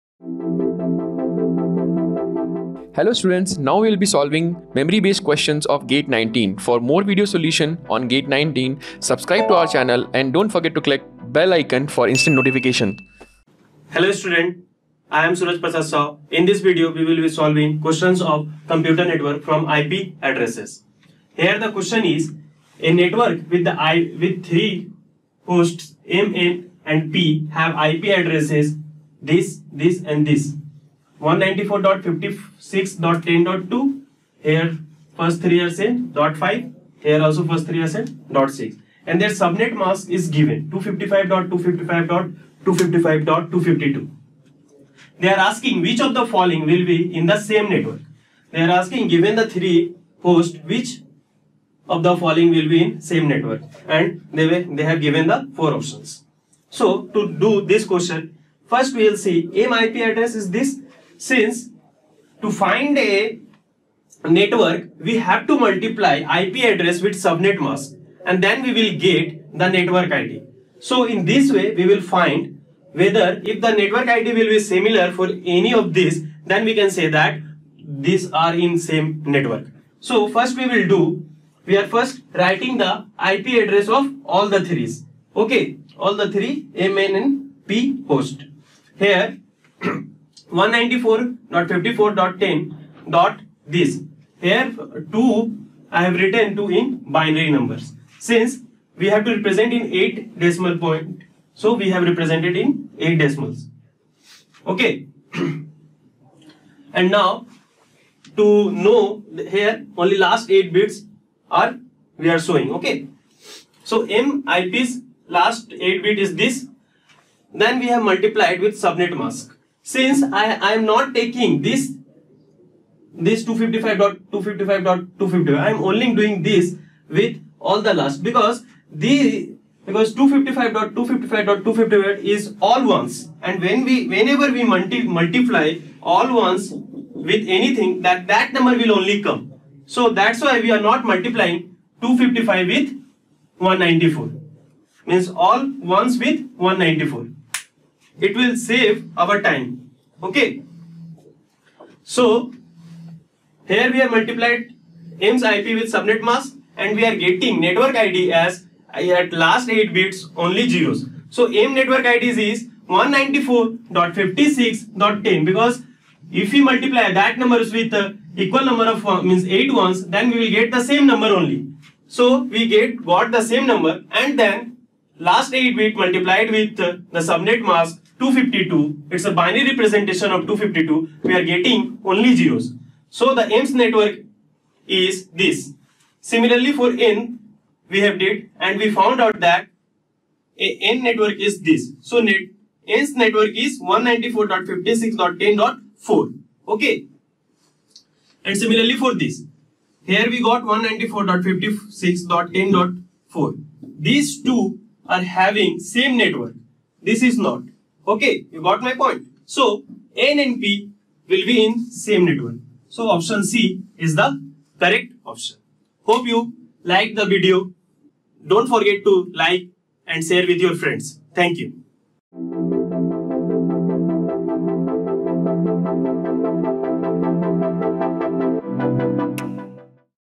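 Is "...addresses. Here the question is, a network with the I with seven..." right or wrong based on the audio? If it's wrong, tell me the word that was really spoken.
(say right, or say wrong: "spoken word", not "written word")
wrong: "three", not "seven".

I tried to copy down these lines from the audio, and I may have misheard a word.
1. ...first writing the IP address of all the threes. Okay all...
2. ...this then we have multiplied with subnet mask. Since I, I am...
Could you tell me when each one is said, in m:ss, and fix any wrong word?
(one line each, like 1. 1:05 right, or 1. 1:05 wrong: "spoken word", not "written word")
1. 1:21 right
2. 1:56 right.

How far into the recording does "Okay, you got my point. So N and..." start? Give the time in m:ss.
3:28.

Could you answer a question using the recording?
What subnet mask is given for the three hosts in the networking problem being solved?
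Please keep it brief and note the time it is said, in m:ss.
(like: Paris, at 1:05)
255.255.255.252, at 0:40.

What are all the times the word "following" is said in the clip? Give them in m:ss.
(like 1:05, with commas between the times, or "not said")
0:46, 0:52.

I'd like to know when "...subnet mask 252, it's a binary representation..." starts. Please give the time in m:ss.
2:57.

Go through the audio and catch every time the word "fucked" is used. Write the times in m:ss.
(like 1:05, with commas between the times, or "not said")
not said.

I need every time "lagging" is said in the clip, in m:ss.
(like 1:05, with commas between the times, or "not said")
not said.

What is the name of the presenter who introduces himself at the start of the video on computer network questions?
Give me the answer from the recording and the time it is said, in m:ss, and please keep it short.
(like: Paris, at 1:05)
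Suraj Prasad Saw, at 0:15.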